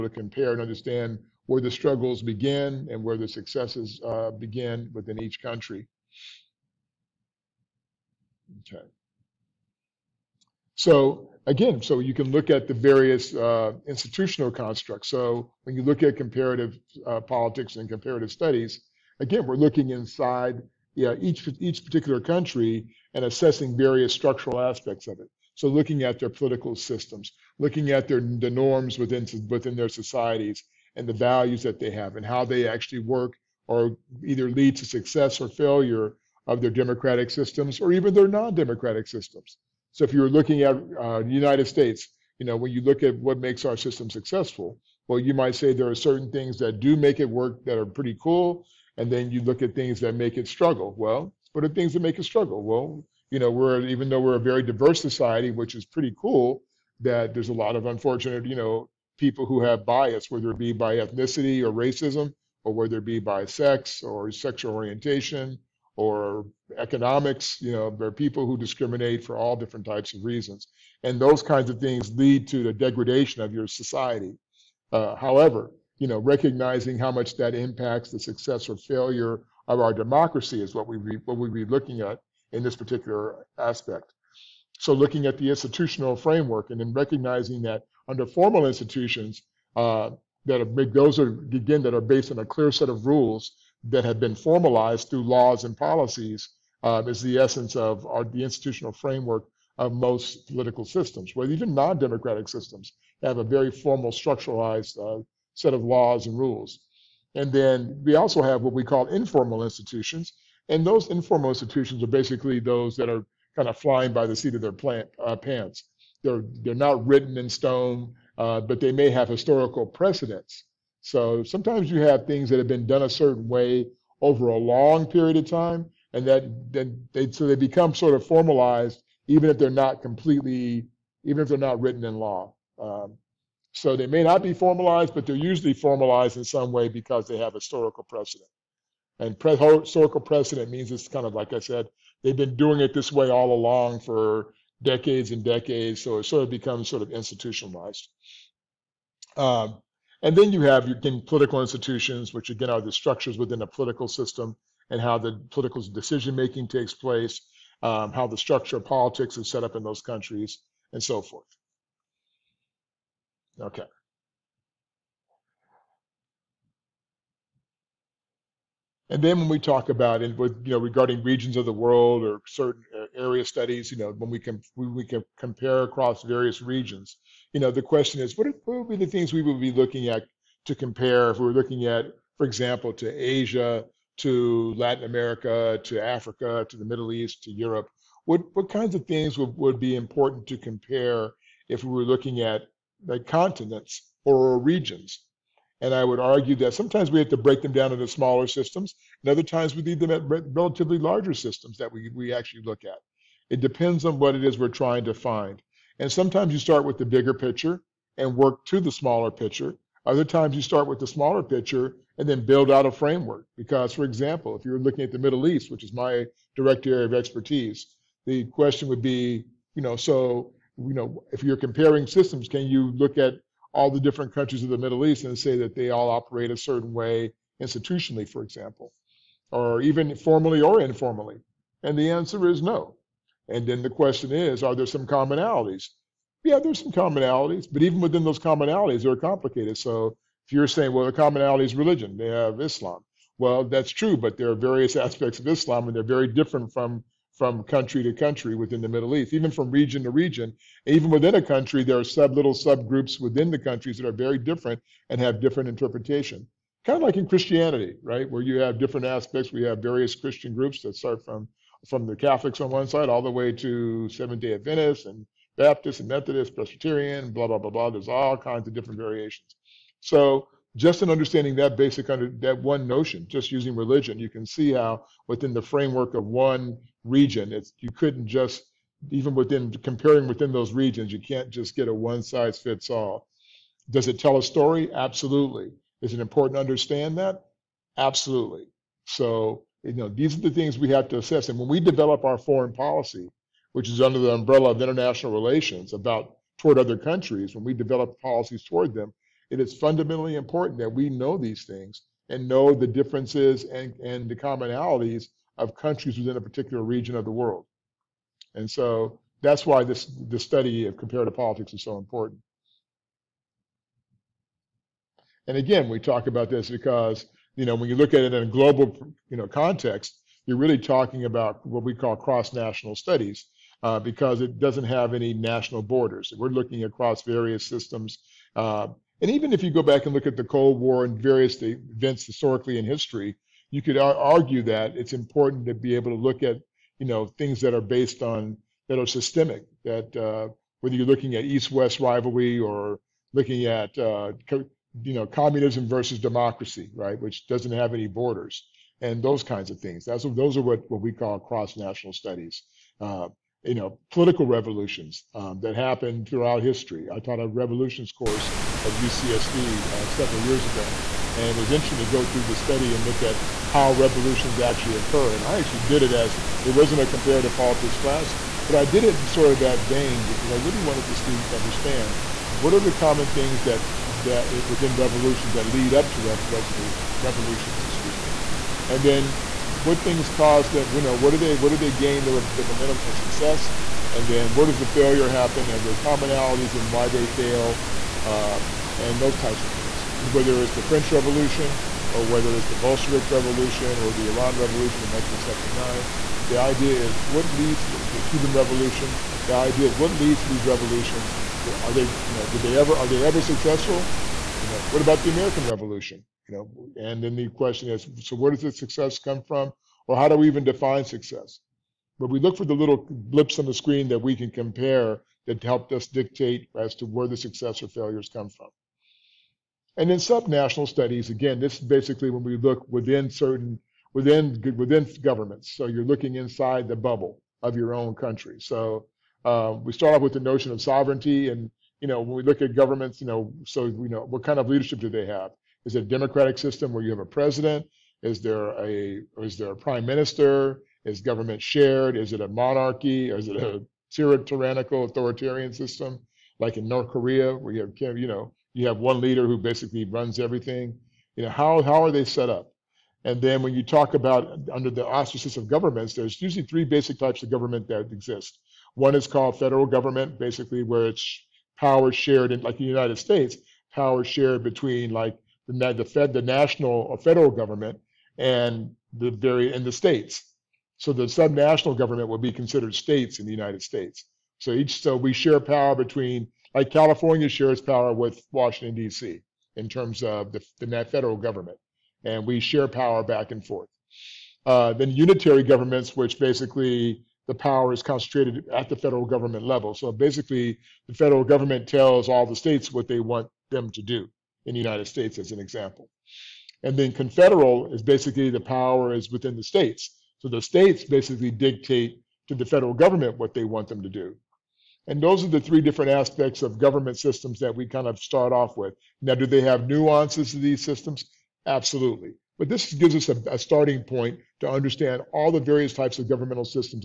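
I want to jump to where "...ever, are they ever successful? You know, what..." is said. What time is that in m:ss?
6:42.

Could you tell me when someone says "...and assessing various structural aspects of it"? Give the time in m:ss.
0:23.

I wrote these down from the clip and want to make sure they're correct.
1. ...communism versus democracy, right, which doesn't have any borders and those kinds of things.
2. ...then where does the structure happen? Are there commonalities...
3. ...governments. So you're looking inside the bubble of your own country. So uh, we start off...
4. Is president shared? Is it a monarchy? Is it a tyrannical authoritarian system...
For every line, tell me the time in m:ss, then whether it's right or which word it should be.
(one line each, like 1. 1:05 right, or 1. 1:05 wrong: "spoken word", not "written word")
1. 5:45 right
2. 6:24 wrong: "failure", not "structure"
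3. 7:05 right
4. 7:21 wrong: "government", not "president".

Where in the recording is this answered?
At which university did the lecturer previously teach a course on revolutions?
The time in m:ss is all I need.
5:58.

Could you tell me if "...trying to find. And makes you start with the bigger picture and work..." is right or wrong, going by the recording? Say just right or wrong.
wrong.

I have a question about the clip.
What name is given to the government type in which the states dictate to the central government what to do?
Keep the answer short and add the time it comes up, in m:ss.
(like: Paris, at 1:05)
confederal, at 8:17.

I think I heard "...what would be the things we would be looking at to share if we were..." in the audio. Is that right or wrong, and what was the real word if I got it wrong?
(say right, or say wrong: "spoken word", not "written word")
wrong: "compare", not "share".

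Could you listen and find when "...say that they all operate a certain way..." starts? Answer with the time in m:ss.
3:45.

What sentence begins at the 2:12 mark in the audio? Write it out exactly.
Um, so they may not be formalized, but they're usually formalized in some way because they have historical precedent.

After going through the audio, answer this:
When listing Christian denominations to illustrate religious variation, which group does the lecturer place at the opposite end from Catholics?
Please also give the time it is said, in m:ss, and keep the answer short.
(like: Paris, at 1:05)
Seventh day Adventists, at 4:24.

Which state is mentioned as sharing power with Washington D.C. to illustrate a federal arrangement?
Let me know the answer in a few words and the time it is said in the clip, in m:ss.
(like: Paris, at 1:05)
California, at 7:56.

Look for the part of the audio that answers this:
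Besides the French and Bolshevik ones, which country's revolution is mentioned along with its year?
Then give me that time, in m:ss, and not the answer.
6:34.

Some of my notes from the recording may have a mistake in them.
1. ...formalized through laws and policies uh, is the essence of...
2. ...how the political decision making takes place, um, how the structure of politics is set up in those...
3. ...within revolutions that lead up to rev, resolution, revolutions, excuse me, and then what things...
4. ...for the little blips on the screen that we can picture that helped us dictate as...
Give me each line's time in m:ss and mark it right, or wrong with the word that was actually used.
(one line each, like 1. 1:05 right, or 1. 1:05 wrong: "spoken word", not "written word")
1. 1:34 right
2. 2:34 right
3. 6:14 right
4. 6:52 wrong: "compare", not "picture".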